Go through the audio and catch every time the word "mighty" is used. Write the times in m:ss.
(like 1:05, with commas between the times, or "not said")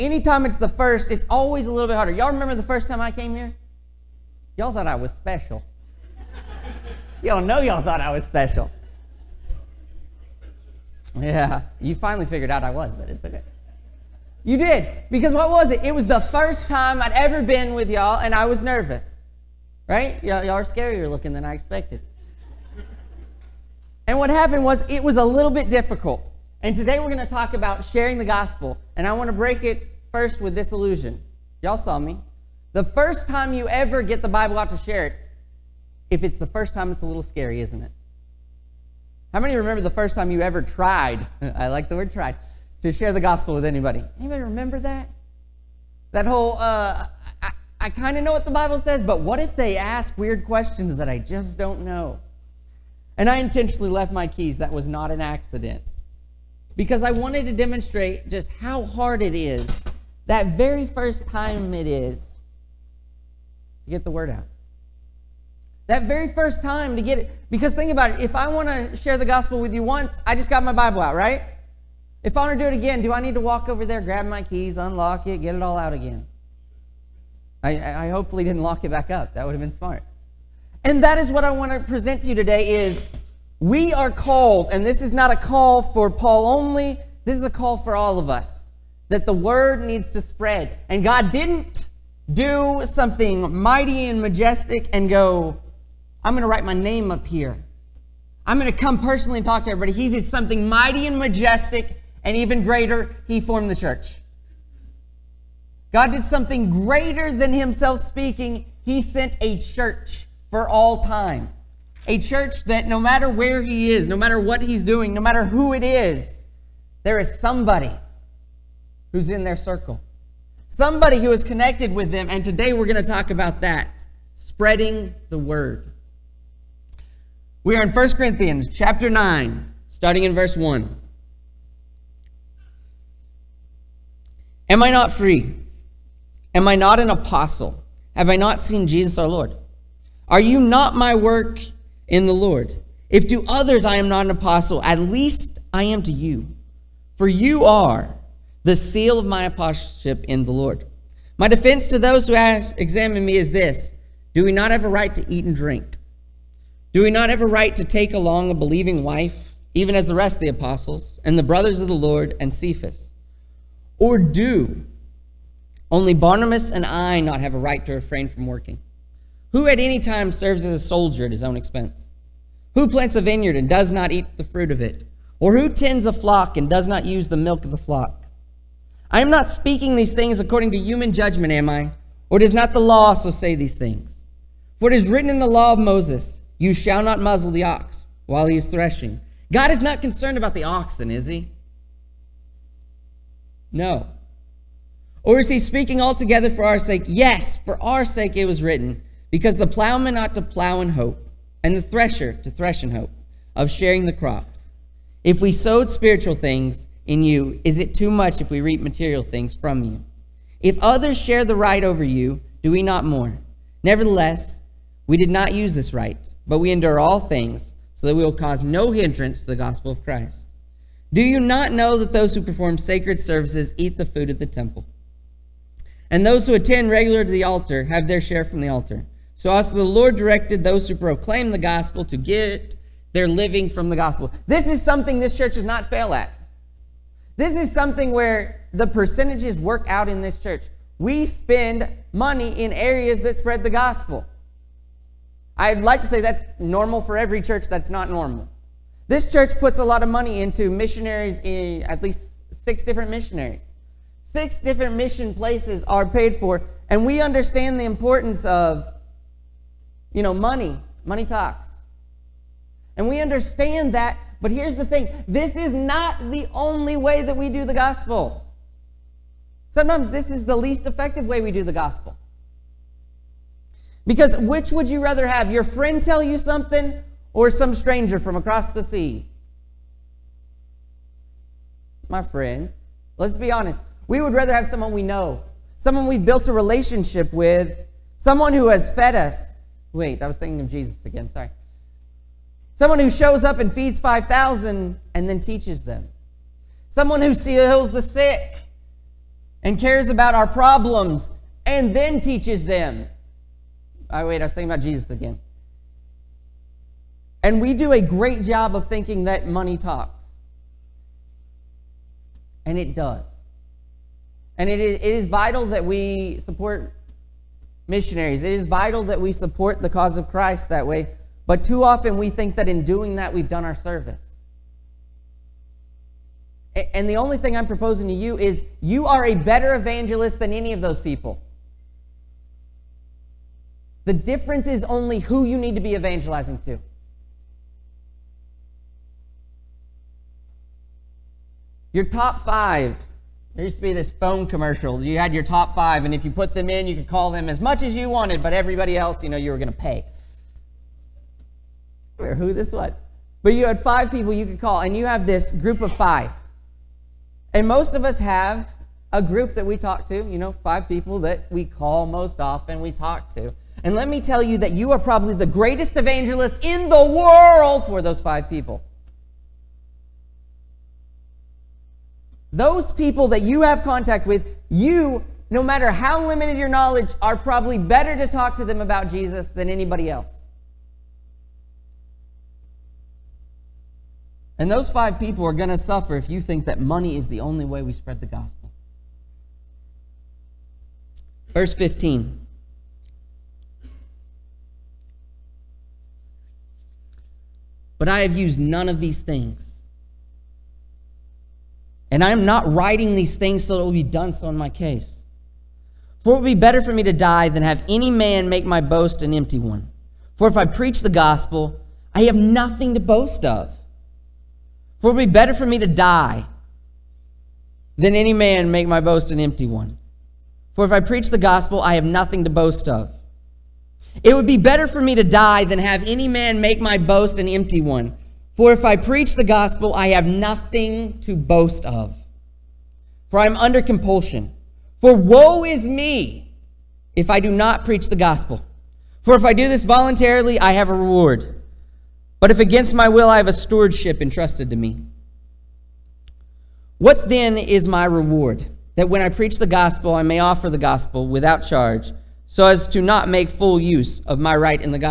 1:33, 1:40.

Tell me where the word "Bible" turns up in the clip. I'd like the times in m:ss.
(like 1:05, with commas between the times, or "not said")
0:34, 0:48, 1:10.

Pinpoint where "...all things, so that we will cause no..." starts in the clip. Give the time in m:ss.
3:37.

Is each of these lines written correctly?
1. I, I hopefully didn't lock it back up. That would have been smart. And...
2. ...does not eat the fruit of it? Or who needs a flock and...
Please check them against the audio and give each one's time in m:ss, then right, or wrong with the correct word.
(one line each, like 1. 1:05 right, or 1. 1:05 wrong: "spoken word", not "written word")
1. 1:17 right
2. 2:53 wrong: "tends", not "needs".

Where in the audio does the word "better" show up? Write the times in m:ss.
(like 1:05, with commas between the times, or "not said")
5:29, 6:17, 6:46, 6:55, 7:04.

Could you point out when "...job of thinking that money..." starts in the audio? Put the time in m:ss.
5:08.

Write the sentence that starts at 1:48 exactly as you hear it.
He sent a church for all time.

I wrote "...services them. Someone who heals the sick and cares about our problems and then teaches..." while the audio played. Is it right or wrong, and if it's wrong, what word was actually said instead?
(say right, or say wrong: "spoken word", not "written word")
wrong: "teaches", not "services".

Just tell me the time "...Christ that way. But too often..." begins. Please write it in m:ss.
5:20.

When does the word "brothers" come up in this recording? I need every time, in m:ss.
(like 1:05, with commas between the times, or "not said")
2:41.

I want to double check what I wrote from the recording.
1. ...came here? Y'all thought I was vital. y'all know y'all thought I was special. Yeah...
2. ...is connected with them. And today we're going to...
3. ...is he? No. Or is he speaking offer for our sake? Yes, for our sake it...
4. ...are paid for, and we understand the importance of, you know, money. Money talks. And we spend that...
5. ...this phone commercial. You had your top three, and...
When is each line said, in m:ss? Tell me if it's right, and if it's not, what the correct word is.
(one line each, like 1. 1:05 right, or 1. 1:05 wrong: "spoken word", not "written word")
1. 0:03 wrong: "special", not "vital"
2. 2:01 right
3. 3:11 wrong: "altogether", not "offer"
4. 4:15 wrong: "understand", not "spend"
5. 5:43 wrong: "five", not "three".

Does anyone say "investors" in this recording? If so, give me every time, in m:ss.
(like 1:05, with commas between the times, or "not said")
not said.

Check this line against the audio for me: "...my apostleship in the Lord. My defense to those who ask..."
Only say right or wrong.
right.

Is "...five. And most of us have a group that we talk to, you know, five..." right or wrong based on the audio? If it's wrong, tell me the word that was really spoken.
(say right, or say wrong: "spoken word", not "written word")
right.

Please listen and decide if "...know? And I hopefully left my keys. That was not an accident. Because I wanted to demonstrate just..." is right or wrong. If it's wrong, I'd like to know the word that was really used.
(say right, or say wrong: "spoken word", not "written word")
wrong: "intentionally", not "hopefully".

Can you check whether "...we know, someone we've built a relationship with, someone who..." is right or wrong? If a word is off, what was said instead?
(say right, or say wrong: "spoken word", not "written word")
right.